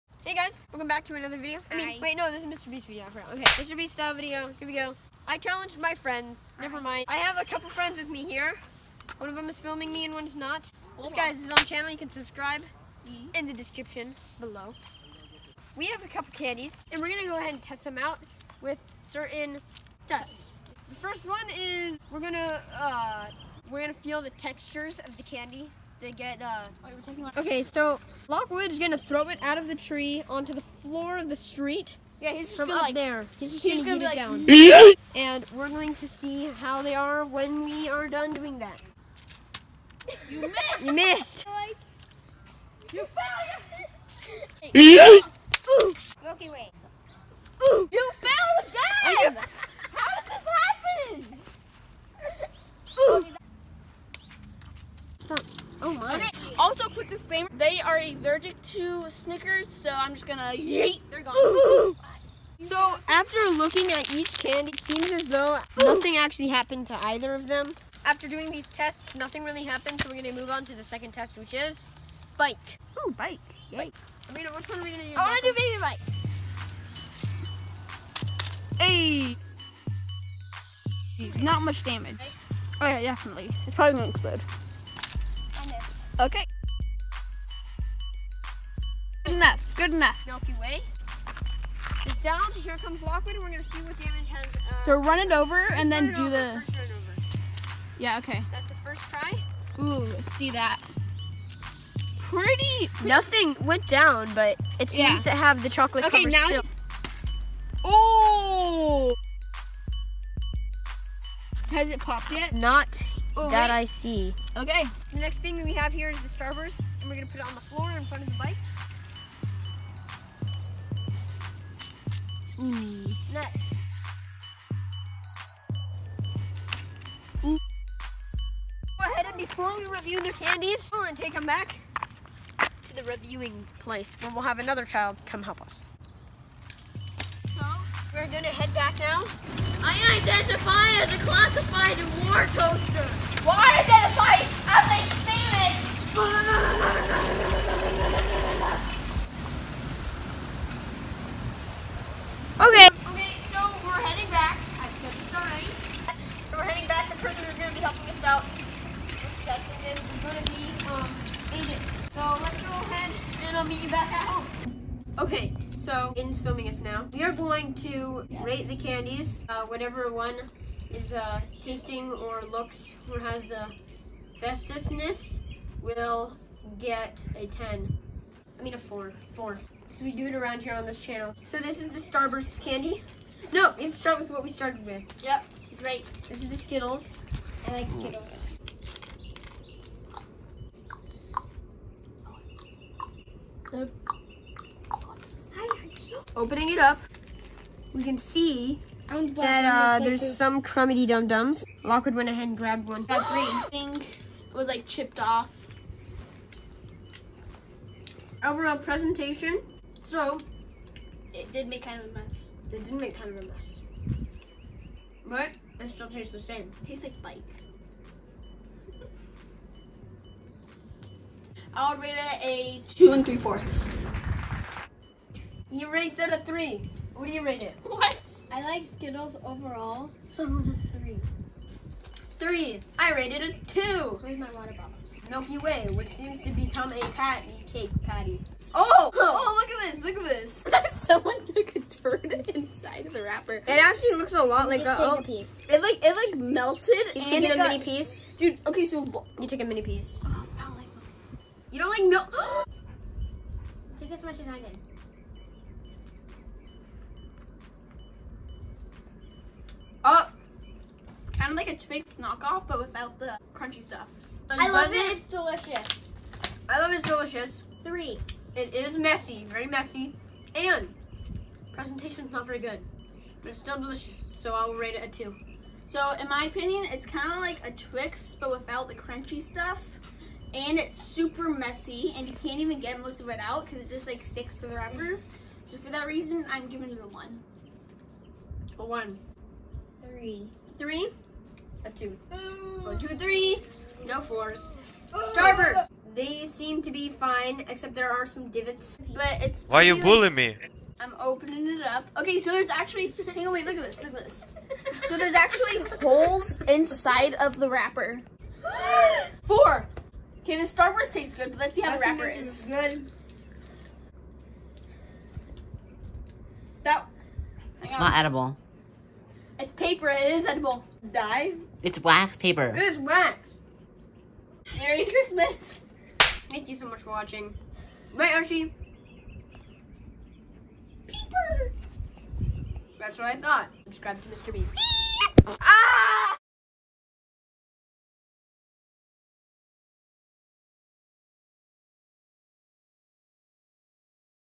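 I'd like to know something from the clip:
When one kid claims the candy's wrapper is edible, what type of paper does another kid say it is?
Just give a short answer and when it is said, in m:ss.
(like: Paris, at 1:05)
wax paper, at 5:21.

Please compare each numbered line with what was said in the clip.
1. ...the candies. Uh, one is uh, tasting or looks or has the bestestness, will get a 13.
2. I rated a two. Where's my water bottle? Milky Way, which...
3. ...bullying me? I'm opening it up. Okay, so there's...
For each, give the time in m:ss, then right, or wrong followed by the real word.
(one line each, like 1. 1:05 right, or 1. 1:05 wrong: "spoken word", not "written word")
1. 2:48 wrong: "10", not "13"
2. 3:52 right
3. 5:00 right.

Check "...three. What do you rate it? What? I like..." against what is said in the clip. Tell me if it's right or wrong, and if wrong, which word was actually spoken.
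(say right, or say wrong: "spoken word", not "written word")
right.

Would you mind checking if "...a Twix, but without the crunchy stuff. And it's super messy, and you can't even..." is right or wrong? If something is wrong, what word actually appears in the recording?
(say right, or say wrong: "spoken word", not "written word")
right.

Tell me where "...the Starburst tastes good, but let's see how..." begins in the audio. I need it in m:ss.
5:10.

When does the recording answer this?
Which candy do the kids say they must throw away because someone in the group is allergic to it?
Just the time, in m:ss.
0:59.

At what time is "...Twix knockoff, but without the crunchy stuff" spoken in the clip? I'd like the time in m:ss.
4:21.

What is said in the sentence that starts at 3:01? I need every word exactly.
So this is the Starburst candy.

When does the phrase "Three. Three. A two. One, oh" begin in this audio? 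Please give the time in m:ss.
4:50.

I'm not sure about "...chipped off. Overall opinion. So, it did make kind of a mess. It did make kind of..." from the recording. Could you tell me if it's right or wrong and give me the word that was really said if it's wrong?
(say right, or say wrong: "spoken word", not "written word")
wrong: "presentation", not "opinion".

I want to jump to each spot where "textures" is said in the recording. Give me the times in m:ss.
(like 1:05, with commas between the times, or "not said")
0:24.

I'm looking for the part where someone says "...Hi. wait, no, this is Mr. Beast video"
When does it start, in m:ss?
0:01.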